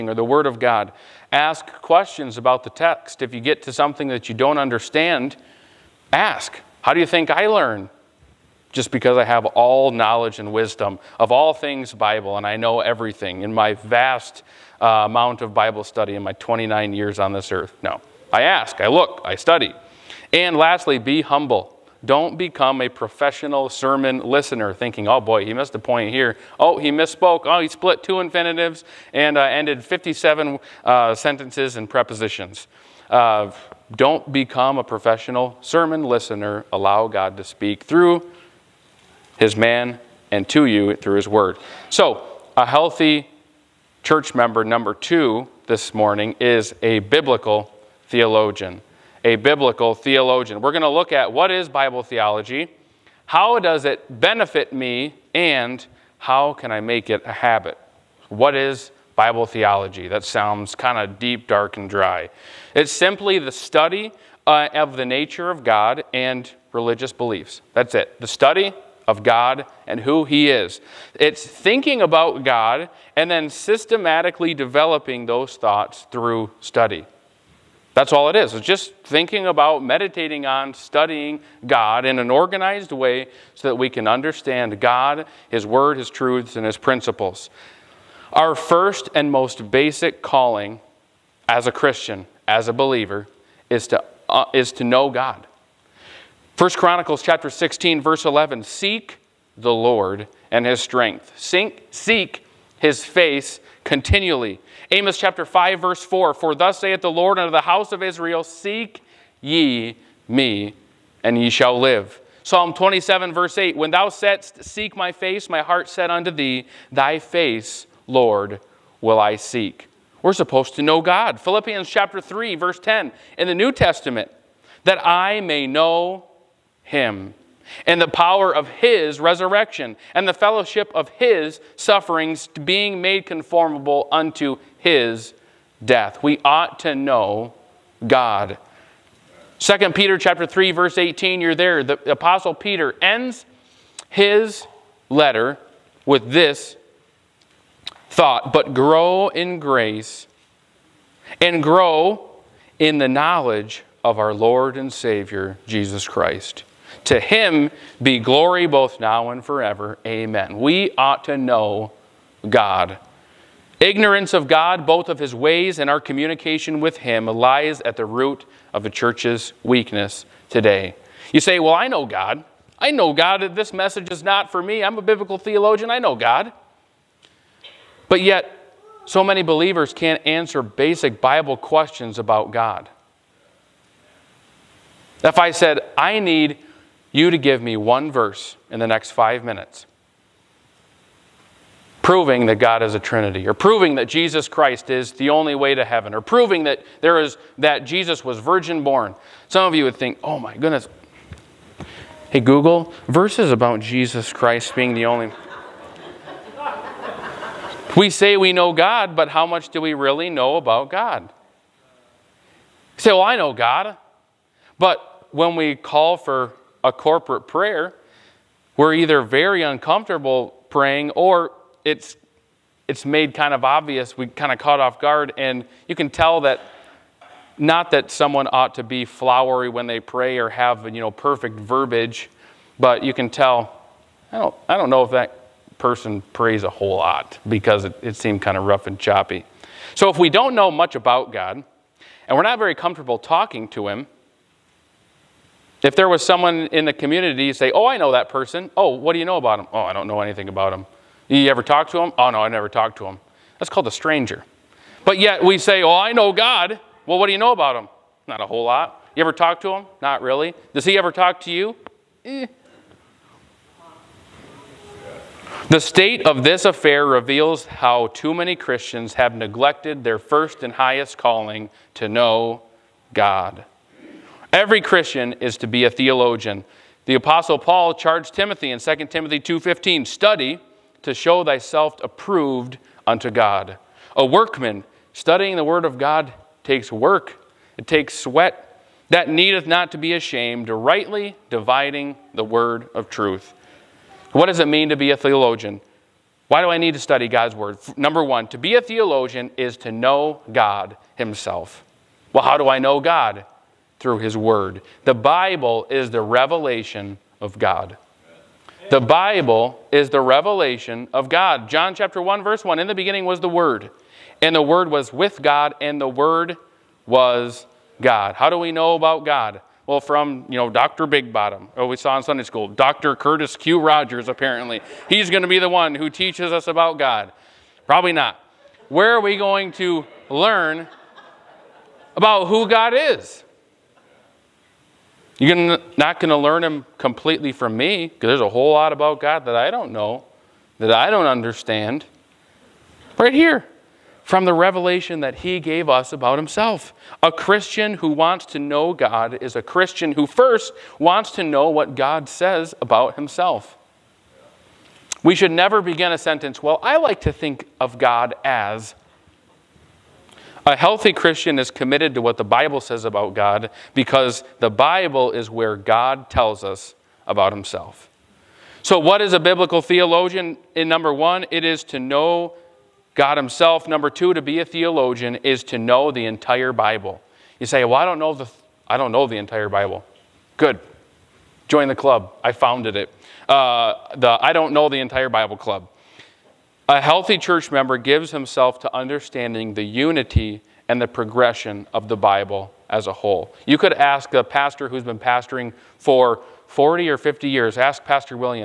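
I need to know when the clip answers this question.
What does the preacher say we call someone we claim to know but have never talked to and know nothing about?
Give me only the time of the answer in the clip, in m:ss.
4:13.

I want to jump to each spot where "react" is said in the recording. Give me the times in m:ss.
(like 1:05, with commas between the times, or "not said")
not said.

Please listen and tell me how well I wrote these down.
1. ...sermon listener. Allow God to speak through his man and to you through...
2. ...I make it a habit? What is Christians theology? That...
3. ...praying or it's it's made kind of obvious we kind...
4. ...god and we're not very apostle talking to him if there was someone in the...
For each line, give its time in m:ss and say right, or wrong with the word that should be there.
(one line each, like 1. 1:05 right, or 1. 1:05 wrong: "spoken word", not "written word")
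1. 0:35 right
2. 0:56 wrong: "Bible", not "Christians"
3. 3:40 right
4. 4:01 wrong: "comfortable", not "apostle".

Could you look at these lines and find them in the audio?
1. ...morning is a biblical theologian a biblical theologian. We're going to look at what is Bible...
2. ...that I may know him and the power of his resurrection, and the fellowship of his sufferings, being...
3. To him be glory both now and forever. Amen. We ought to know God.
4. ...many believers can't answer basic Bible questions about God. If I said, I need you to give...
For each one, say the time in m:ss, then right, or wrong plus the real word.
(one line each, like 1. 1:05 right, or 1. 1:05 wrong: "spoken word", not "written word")
1. 0:45 right
2. 2:04 right
3. 2:37 right
4. 2:59 right.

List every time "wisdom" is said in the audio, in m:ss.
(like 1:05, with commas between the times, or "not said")
0:10.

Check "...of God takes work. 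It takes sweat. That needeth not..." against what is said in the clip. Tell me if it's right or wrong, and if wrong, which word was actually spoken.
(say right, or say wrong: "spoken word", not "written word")
right.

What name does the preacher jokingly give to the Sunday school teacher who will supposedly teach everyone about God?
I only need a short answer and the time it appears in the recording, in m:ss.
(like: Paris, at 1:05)
Dr. Curtis Q. Rogers, at 5:22.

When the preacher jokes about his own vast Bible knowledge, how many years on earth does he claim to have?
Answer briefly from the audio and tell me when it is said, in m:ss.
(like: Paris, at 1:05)
29, at 0:16.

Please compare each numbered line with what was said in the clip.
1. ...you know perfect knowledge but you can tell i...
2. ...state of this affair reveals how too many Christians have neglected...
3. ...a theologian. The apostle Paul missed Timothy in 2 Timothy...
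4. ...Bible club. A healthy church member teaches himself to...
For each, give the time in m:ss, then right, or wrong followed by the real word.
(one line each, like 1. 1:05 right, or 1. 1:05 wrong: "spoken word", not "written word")
1. 3:50 wrong: "verbiage", not "knowledge"
2. 4:25 right
3. 4:35 wrong: "charged", not "missed"
4. 6:25 wrong: "gives", not "teaches".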